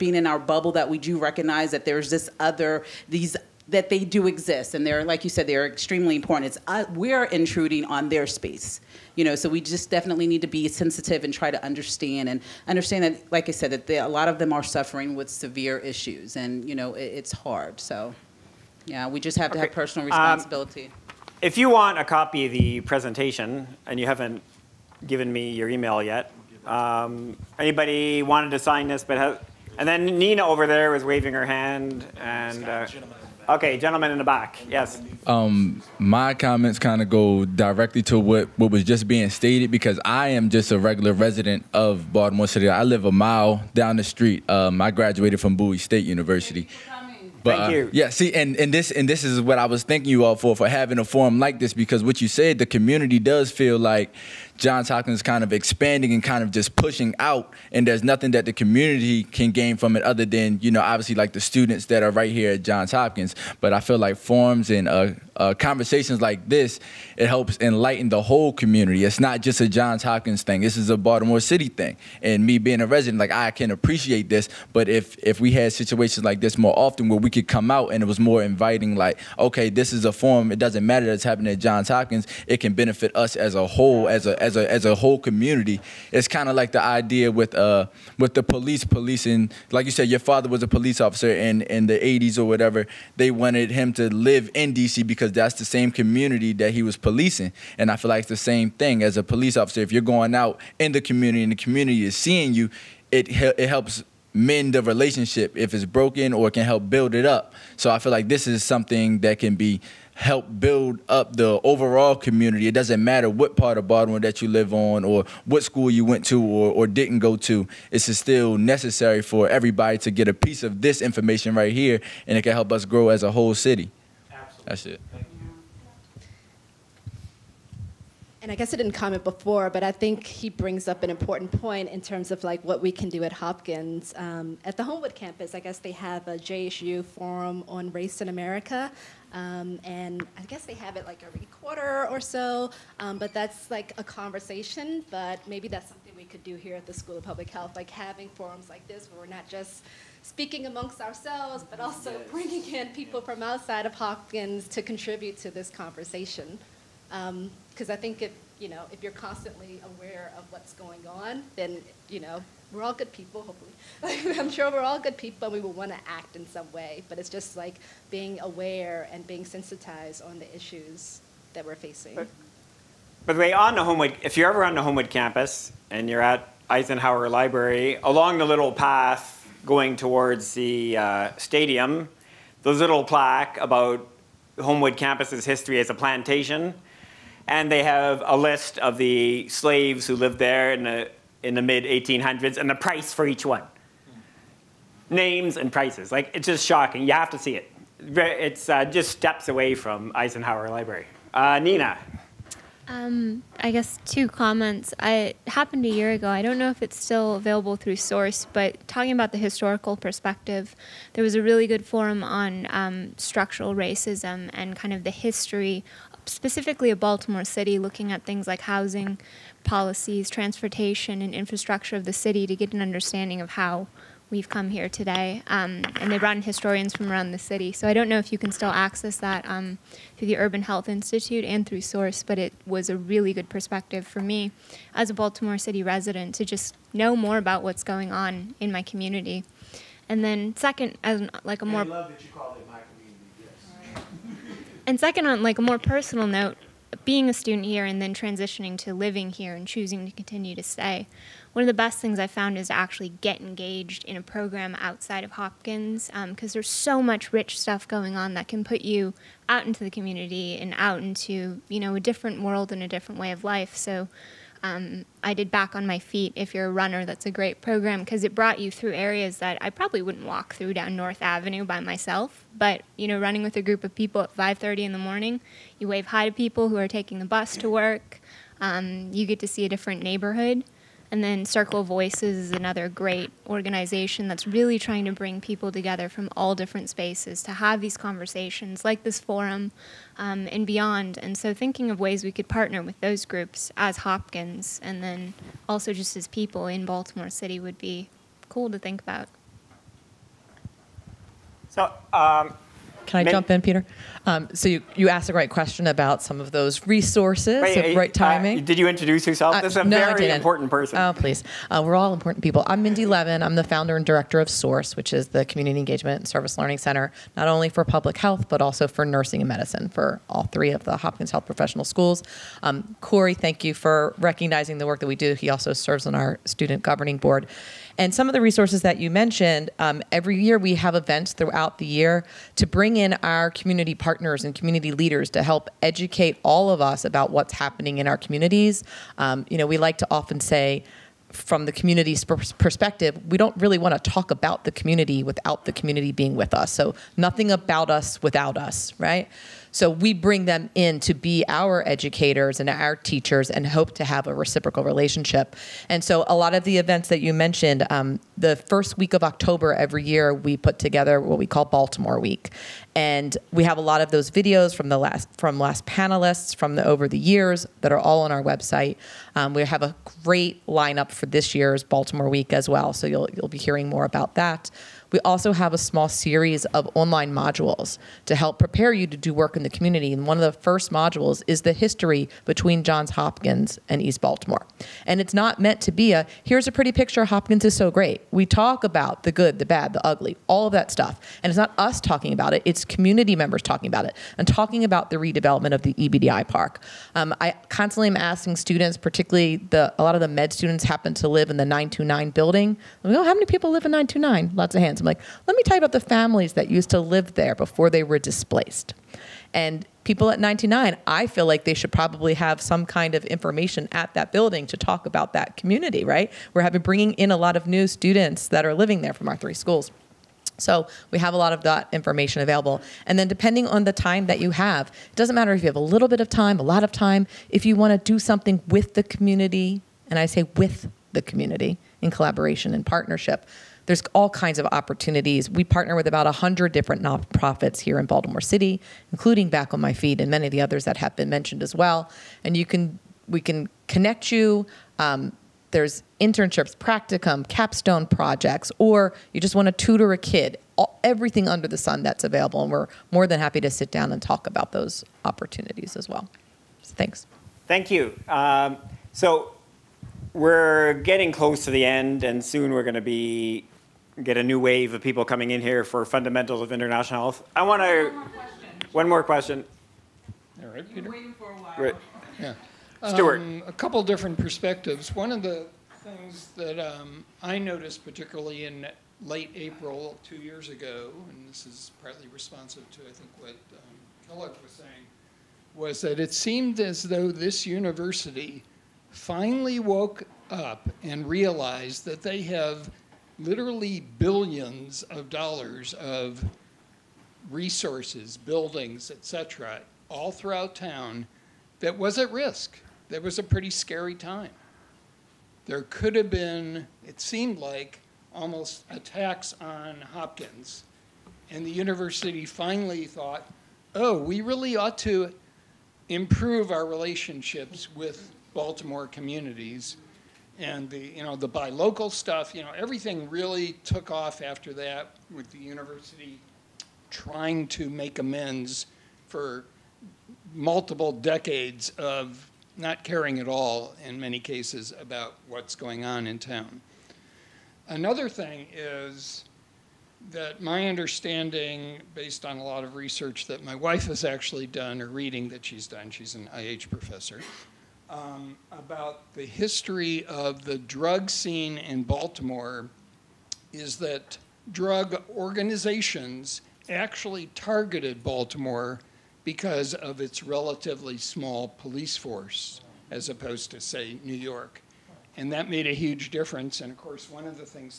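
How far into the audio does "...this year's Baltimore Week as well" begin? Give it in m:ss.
6:11.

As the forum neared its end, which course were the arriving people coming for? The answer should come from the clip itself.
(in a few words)
fundamentals of international health.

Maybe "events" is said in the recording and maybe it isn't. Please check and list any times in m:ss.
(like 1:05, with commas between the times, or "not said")
5:30, 5:56.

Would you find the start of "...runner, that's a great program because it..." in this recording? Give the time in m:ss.
4:26.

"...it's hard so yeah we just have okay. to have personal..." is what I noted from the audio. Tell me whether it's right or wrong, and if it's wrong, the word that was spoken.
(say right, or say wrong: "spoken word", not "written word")
right.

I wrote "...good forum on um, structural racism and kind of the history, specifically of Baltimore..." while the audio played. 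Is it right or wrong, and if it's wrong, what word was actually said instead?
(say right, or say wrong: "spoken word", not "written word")
right.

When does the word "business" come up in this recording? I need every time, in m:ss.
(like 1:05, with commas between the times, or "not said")
not said.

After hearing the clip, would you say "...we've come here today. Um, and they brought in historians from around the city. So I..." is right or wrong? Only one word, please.
right.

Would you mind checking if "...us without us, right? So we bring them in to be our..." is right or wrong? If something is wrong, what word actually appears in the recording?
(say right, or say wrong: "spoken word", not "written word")
right.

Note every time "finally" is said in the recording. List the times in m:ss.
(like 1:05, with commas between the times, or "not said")
8:09, 8:32.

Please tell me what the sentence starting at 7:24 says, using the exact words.
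Um, there's internships, practicum, capstone projects, or you just want to tutor a kid.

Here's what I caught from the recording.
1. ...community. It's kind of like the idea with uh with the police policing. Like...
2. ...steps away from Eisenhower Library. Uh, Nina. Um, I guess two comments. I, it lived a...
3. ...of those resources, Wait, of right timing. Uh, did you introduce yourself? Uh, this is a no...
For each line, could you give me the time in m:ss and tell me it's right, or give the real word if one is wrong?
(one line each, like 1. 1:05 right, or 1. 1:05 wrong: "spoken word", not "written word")
1. 1:25 right
2. 3:19 wrong: "happened", not "lived"
3. 5:06 right.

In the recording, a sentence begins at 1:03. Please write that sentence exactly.
But I feel like forums and uh, uh, conversations like this, it helps enlighten the whole community.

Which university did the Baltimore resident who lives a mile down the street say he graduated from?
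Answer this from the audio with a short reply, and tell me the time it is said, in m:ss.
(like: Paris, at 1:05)
Bowie State University, at 0:45.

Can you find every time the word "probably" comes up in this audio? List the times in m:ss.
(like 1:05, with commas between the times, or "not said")
4:29, 6:51.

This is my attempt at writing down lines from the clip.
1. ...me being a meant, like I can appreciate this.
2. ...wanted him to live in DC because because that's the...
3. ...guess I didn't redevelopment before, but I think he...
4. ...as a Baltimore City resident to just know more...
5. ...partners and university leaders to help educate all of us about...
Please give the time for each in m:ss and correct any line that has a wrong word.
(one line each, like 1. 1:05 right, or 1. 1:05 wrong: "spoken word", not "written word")
1. 1:12 wrong: "resident", not "meant"
2. 1:33 right
3. 2:08 wrong: "comment", not "redevelopment"
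4. 3:54 right
5. 5:33 wrong: "community", not "university".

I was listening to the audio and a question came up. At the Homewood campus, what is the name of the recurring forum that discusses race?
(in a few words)
JHU forum on race in America.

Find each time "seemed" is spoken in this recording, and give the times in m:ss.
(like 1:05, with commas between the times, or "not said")
8:06, 8:27.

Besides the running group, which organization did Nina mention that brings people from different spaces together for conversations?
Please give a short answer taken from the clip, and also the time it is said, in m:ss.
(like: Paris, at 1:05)
Circle Voices, at 4:41.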